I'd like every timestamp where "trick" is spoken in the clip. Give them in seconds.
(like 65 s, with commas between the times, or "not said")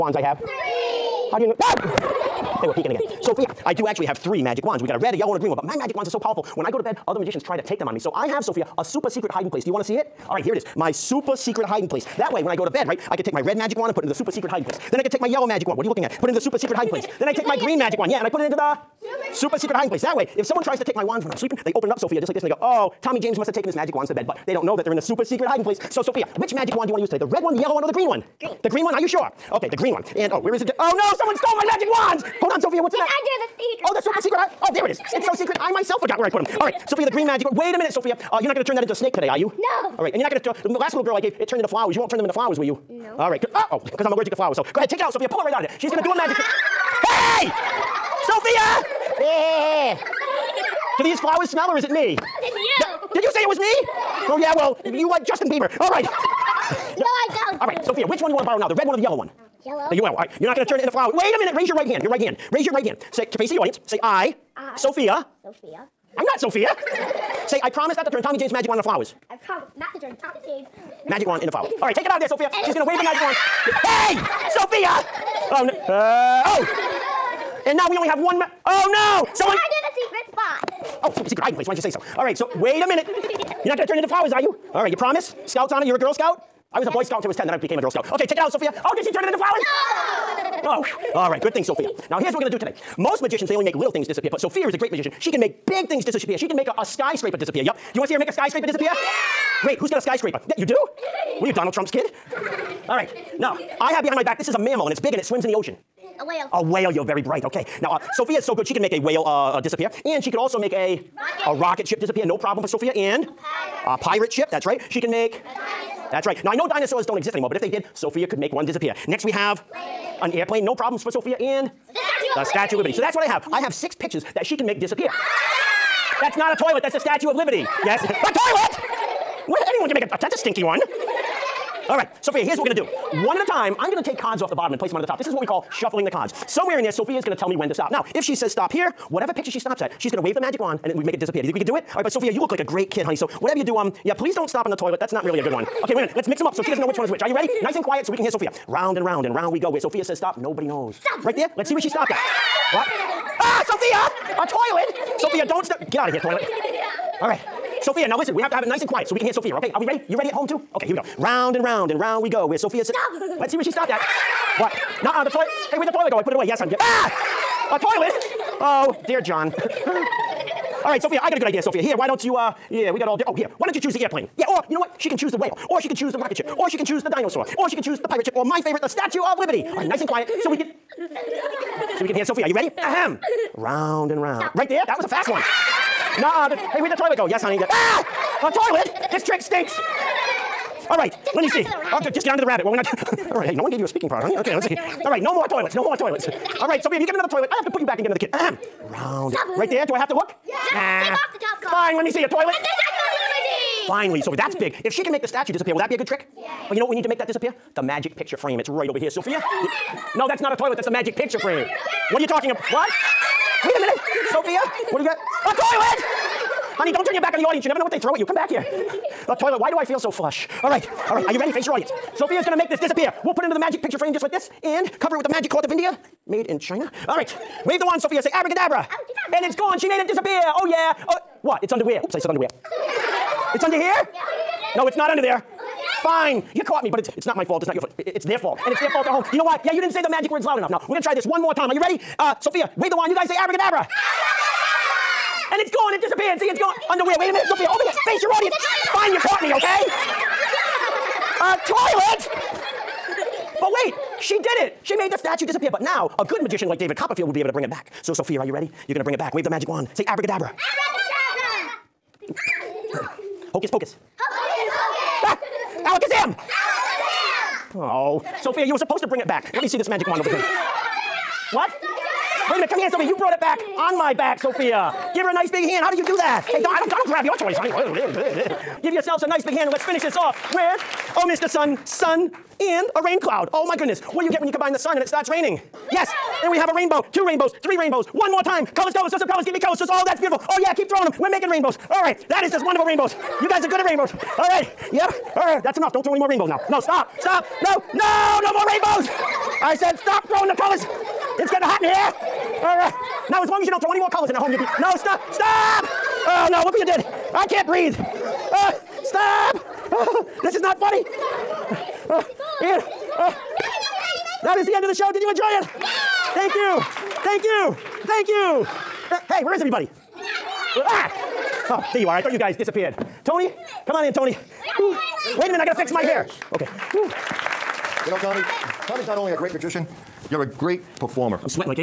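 46 s, 189 s, 206 s.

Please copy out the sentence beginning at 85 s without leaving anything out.
Scouts honor, you're a Girl Scout?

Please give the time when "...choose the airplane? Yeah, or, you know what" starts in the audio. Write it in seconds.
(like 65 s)
173 s.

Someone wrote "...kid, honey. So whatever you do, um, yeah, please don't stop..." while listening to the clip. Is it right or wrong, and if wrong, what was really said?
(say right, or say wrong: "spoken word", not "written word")
right.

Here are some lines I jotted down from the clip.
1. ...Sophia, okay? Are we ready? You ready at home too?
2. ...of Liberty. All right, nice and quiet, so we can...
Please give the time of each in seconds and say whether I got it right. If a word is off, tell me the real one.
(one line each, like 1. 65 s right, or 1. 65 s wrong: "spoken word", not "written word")
1. 159 s right
2. 179 s right.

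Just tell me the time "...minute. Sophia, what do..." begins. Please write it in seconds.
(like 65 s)
213 s.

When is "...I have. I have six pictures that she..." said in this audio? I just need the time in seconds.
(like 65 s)
123 s.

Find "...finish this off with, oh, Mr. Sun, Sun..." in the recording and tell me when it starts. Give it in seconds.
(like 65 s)
279 s.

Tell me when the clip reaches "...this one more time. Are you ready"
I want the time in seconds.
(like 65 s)
241 s.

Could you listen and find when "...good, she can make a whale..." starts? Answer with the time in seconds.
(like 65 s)
108 s.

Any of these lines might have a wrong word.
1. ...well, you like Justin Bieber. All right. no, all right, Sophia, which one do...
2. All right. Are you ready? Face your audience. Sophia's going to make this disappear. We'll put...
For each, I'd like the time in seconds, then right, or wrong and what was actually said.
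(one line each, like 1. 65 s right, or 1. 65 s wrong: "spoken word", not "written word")
1. 54 s right
2. 221 s right.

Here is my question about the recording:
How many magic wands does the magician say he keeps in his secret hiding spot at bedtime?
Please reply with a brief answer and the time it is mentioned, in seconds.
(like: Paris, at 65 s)
3, at 4 s.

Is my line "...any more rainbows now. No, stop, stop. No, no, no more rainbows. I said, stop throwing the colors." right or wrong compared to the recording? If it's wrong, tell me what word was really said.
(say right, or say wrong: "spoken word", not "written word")
right.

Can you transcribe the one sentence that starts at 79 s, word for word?
Someone- Oh, super secret hiding place.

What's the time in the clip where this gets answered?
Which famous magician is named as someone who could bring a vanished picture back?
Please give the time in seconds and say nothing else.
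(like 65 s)
256 s.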